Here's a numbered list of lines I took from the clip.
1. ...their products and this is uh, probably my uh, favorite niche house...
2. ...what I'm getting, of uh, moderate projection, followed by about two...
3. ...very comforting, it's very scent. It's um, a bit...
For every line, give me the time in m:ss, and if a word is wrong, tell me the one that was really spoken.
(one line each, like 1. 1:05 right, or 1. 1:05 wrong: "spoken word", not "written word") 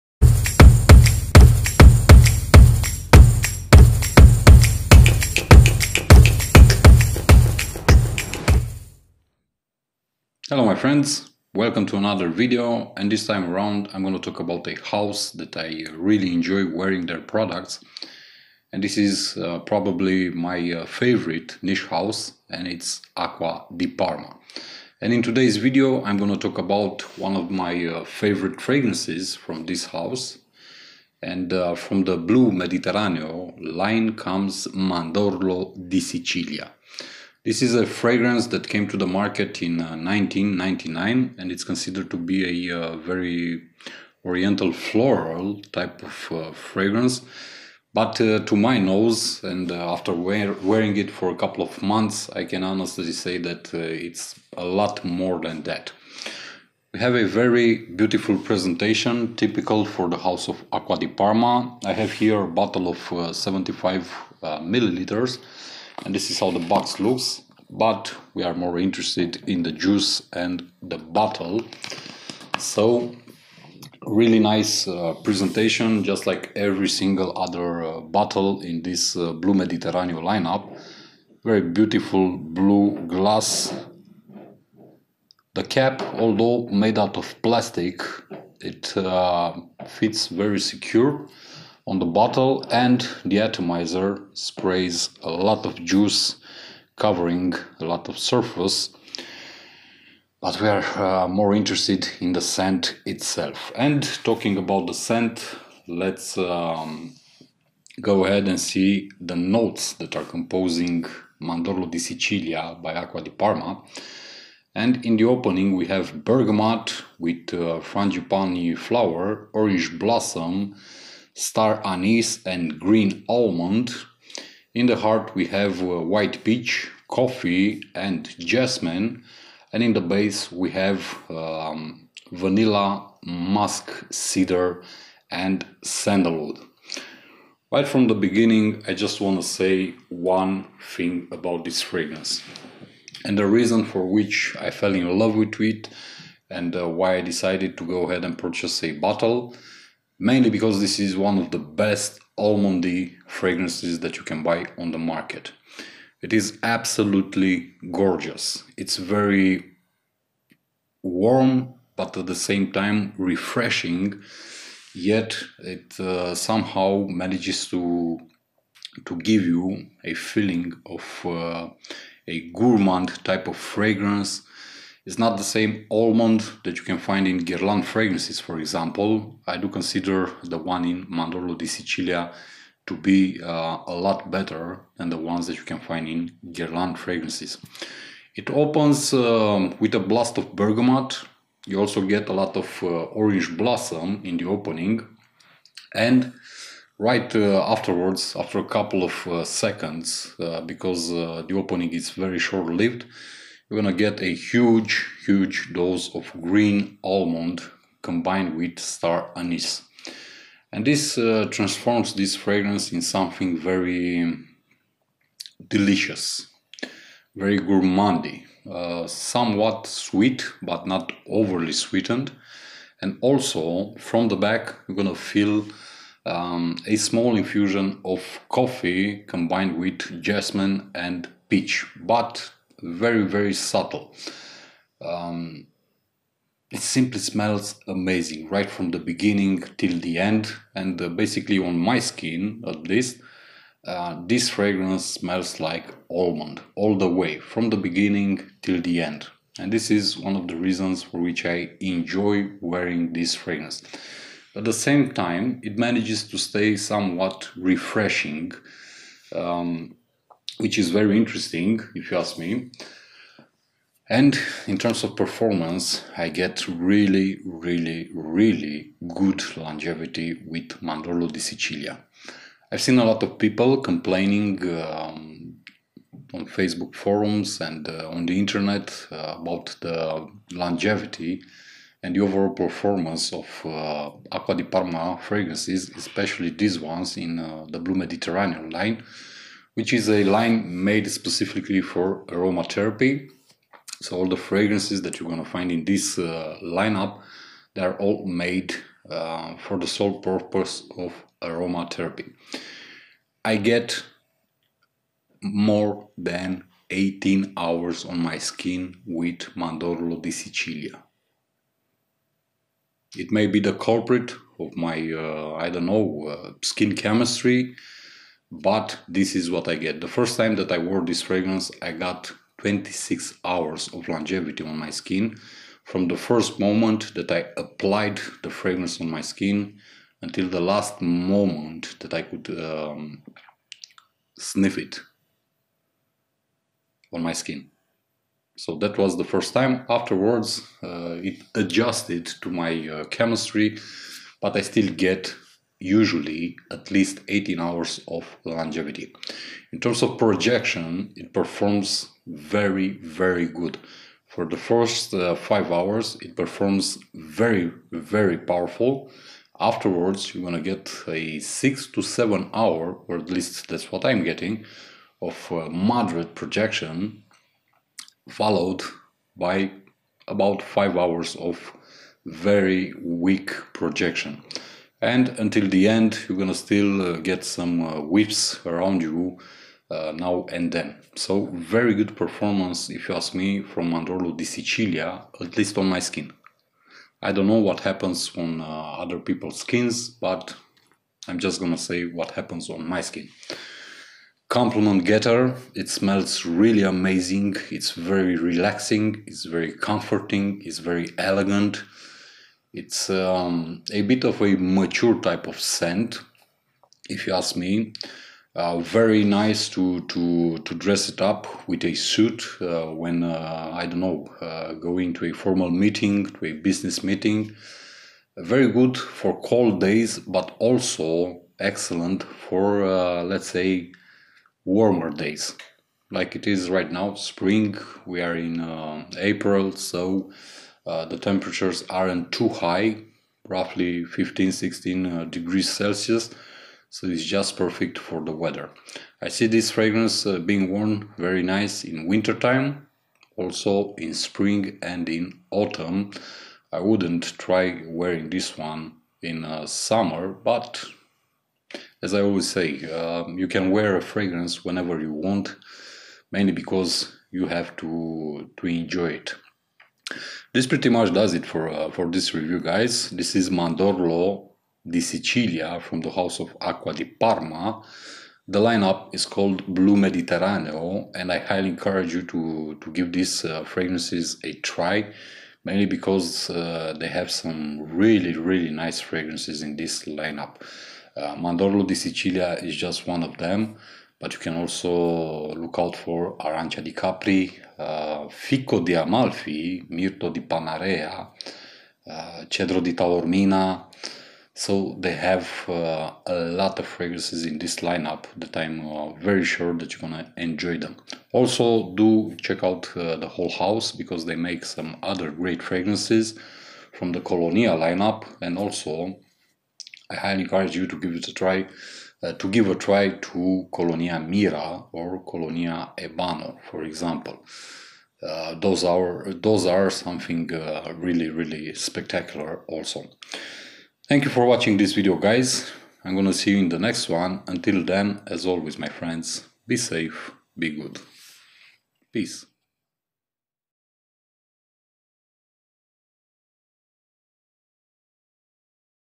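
1. 0:17 right
2. 6:03 wrong: "five", not "two"
3. 6:39 wrong: "elegant", not "scent".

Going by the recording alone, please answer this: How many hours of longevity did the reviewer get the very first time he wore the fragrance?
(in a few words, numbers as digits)
26 hours.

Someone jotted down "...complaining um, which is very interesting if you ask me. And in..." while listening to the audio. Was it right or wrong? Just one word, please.
wrong.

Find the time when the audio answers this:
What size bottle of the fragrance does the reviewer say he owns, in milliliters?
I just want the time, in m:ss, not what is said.
1:03.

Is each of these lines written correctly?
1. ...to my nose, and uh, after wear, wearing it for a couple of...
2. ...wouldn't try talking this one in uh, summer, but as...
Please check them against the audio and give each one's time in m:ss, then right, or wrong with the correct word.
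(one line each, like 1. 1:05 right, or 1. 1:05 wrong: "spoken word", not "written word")
1. 0:48 right
2. 7:26 wrong: "wearing", not "talking".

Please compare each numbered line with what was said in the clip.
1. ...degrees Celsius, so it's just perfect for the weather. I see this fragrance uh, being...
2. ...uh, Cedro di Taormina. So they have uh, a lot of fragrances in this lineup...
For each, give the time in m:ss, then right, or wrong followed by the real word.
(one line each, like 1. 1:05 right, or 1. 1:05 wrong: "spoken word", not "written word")
1. 7:15 right
2. 8:12 right.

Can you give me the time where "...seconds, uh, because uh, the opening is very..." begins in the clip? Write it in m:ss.
3:19.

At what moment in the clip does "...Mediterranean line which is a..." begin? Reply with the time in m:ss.
4:47.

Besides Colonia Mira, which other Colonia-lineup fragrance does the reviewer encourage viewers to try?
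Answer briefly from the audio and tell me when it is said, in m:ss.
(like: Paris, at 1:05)
Colonia Ebano, at 8:35.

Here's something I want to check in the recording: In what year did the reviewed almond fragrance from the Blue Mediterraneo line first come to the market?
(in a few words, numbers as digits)
1999.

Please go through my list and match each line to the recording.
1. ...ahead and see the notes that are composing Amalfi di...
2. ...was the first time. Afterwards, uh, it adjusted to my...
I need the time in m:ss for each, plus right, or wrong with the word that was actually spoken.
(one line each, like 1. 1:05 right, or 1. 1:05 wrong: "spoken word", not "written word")
1. 1:48 wrong: "Mandorlo", not "Amalfi"
2. 5:38 right.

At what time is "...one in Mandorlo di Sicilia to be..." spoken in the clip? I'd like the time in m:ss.
3:00.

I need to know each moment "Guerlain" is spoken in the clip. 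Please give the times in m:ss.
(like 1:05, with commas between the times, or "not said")
2:57, 3:06.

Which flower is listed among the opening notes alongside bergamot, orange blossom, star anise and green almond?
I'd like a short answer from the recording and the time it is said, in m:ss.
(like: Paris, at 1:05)
Frangipani, at 1:57.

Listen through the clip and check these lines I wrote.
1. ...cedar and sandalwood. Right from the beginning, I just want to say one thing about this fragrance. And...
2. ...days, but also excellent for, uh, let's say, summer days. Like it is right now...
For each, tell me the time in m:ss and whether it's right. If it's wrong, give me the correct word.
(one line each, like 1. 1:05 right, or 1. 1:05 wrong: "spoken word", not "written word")
1. 2:14 right
2. 6:59 wrong: "warmer", not "summer".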